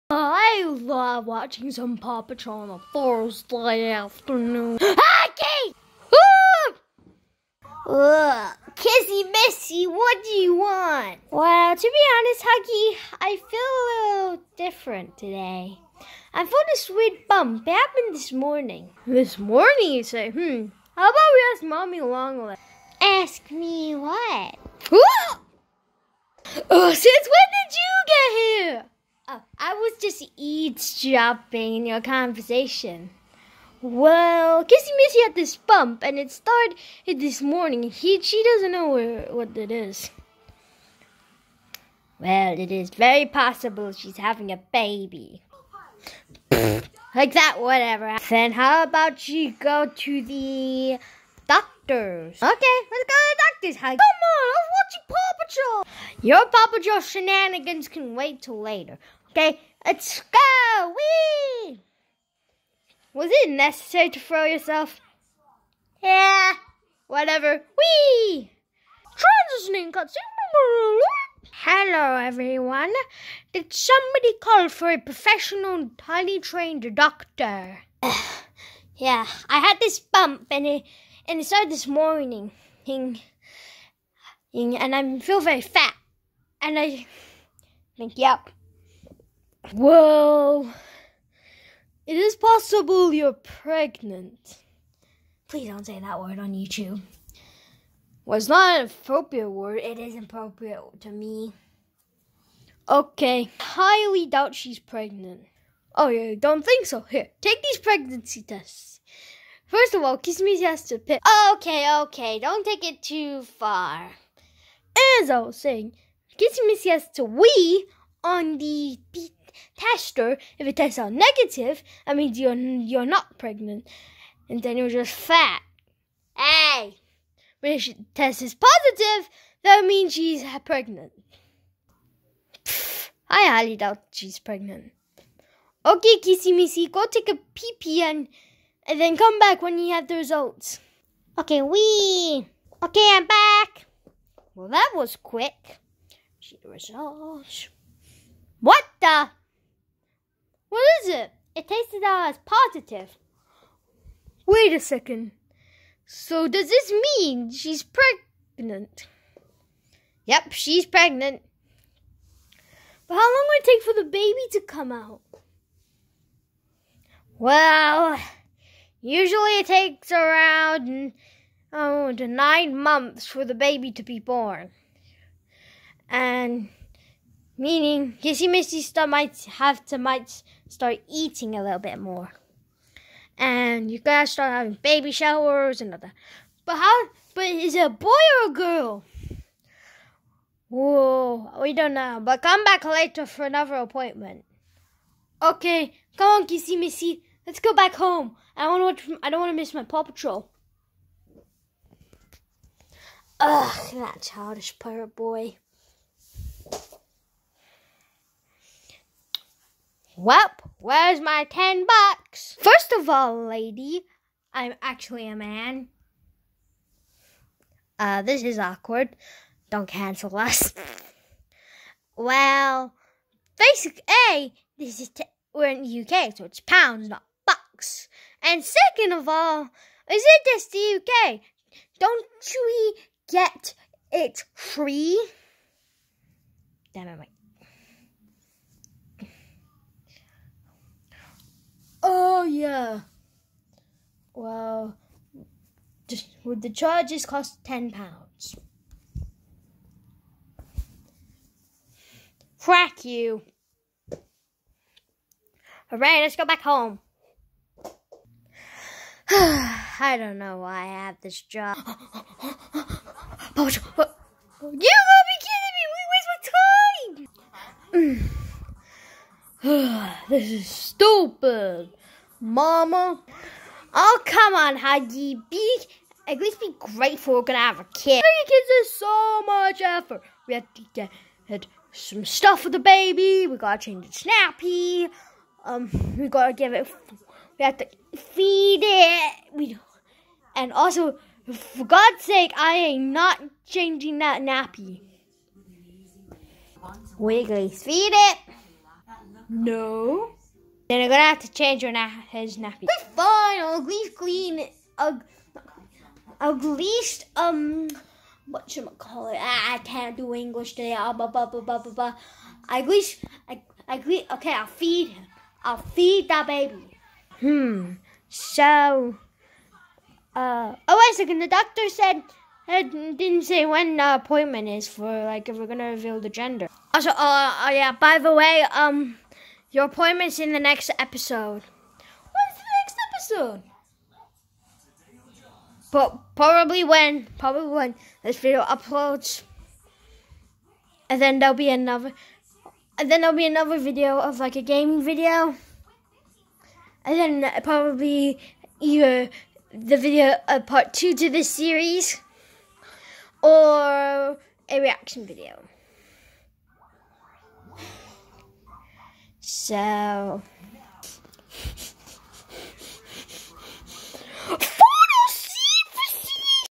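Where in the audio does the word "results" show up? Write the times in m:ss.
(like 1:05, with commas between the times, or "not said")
2:20, 2:26.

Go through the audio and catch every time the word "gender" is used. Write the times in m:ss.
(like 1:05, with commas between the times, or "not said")
5:26.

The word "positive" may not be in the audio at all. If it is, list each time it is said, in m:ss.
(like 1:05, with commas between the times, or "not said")
2:08, 2:32.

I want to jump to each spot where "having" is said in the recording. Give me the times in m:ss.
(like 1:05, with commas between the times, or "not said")
0:44, 3:04, 4:38.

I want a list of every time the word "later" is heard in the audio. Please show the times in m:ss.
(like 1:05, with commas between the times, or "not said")
0:58, 3:12.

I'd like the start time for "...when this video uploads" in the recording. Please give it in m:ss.
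5:37.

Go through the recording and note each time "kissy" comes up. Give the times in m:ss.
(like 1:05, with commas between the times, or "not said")
0:08, 0:34, 1:50, 1:56, 2:16, 2:58, 3:16.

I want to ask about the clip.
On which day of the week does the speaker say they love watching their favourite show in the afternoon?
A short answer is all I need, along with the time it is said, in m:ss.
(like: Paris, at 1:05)
Thursday, at 0:02.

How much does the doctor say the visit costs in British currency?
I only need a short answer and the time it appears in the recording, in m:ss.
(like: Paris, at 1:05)
£10, at 4:07.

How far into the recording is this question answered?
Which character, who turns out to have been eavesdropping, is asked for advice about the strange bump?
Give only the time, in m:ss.
0:21.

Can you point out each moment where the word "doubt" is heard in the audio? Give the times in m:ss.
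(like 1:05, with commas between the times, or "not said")
1:44, 2:13.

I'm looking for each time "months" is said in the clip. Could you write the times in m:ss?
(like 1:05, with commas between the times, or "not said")
2:52.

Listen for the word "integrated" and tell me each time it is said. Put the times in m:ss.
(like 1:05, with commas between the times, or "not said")
not said.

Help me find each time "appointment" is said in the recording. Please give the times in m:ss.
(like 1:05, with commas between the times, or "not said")
3:13, 5:24, 5:29.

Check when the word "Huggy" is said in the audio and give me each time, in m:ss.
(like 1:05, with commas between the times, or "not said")
0:12, 4:34.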